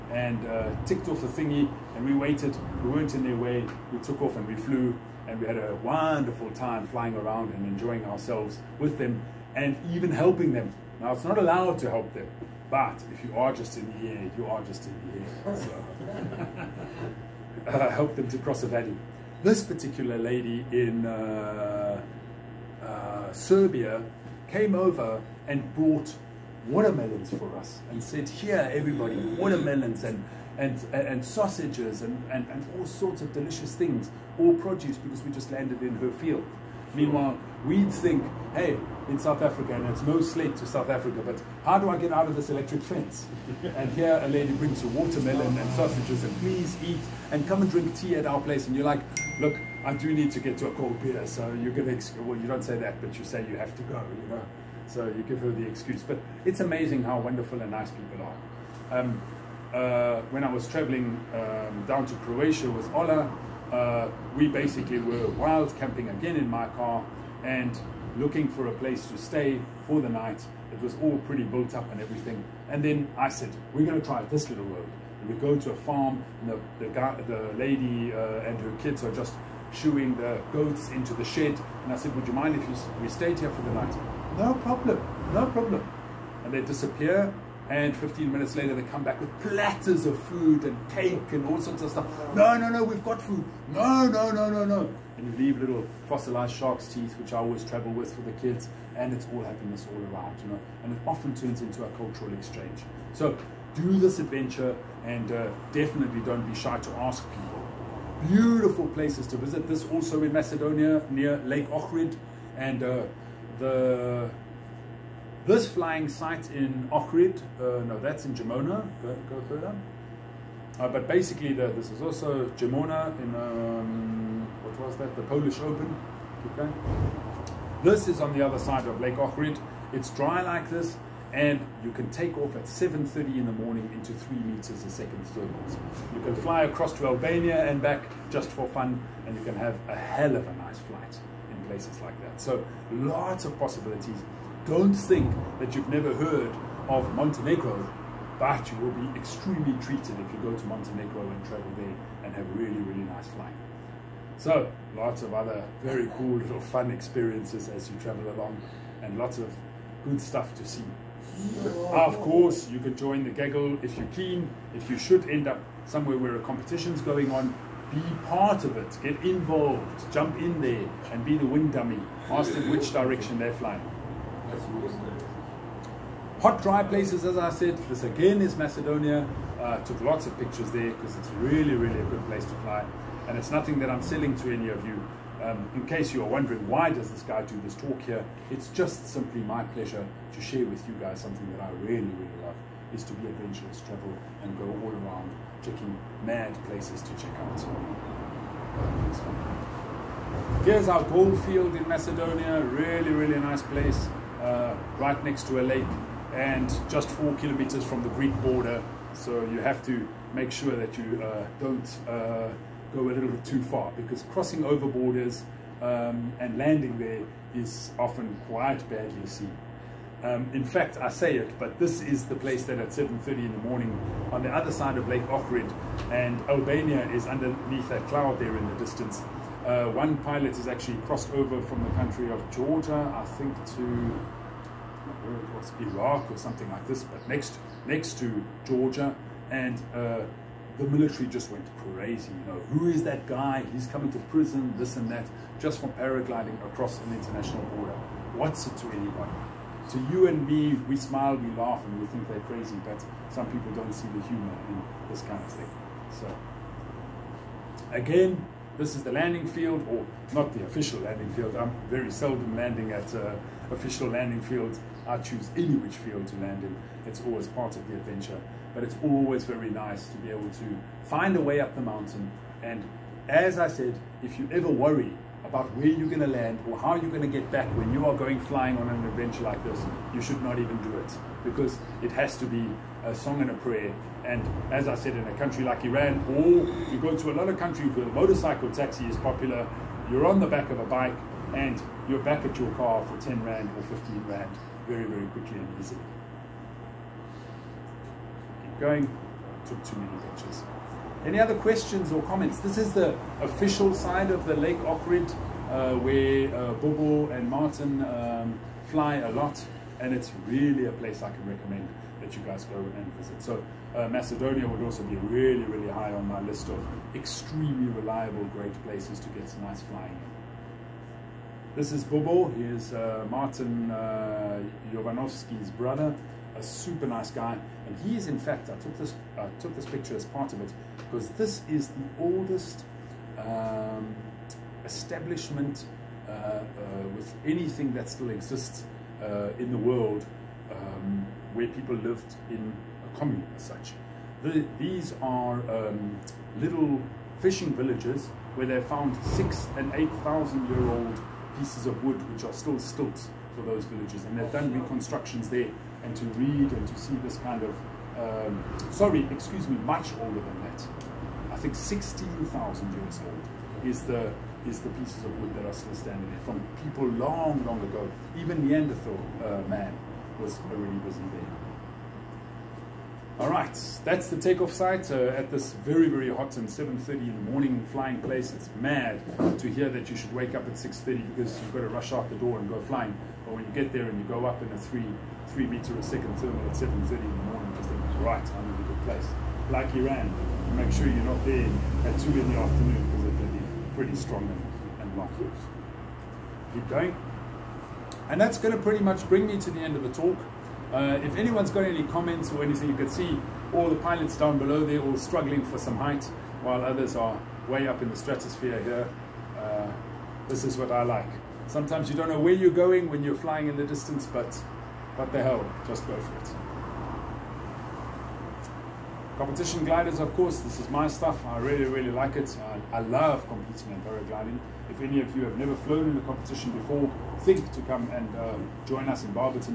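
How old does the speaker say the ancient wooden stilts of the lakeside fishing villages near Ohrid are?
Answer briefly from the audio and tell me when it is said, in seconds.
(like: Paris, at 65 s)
16,000 years, at 361 s.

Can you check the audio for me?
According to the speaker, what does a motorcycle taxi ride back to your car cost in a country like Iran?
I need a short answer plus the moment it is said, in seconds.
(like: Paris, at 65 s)
10 Rand, at 293 s.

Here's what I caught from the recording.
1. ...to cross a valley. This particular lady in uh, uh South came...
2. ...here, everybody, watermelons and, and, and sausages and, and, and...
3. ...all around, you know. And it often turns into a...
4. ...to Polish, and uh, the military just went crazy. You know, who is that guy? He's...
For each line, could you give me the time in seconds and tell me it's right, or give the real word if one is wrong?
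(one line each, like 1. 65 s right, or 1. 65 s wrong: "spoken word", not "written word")
1. 18 s wrong: "Serbia", not "South"
2. 28 s right
3. 99 s right
4. 238 s wrong: "Georgia", not "Polish".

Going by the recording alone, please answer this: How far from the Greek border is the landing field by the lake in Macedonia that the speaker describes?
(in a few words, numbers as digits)
4 kilometers.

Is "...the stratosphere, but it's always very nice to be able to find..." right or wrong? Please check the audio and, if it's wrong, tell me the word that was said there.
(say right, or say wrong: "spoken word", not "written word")
wrong: "adventure", not "stratosphere".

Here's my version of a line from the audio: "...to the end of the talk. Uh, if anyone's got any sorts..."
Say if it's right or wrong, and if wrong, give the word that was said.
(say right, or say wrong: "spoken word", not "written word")
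wrong: "comments", not "sorts".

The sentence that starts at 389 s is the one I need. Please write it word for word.
Like Iran, you make sure you're not there at 2 in the afternoon because they're pretty, pretty strong and, and locked.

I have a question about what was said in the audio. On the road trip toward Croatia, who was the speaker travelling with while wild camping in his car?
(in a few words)
Ola.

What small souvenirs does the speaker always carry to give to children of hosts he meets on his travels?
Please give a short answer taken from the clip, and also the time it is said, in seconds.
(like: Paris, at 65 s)
Fossilized shark's teeth, at 96 s.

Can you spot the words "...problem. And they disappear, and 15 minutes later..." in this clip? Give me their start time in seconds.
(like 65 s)
85 s.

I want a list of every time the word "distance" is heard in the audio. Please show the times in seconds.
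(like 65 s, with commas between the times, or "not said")
228 s, 413 s.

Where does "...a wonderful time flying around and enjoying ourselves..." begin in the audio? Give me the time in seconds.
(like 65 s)
5 s.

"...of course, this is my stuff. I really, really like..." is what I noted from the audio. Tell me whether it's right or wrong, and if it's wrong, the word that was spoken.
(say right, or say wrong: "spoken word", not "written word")
right.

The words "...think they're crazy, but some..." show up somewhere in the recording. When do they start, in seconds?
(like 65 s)
252 s.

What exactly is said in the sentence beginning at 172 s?
Ask them which direction they're flying.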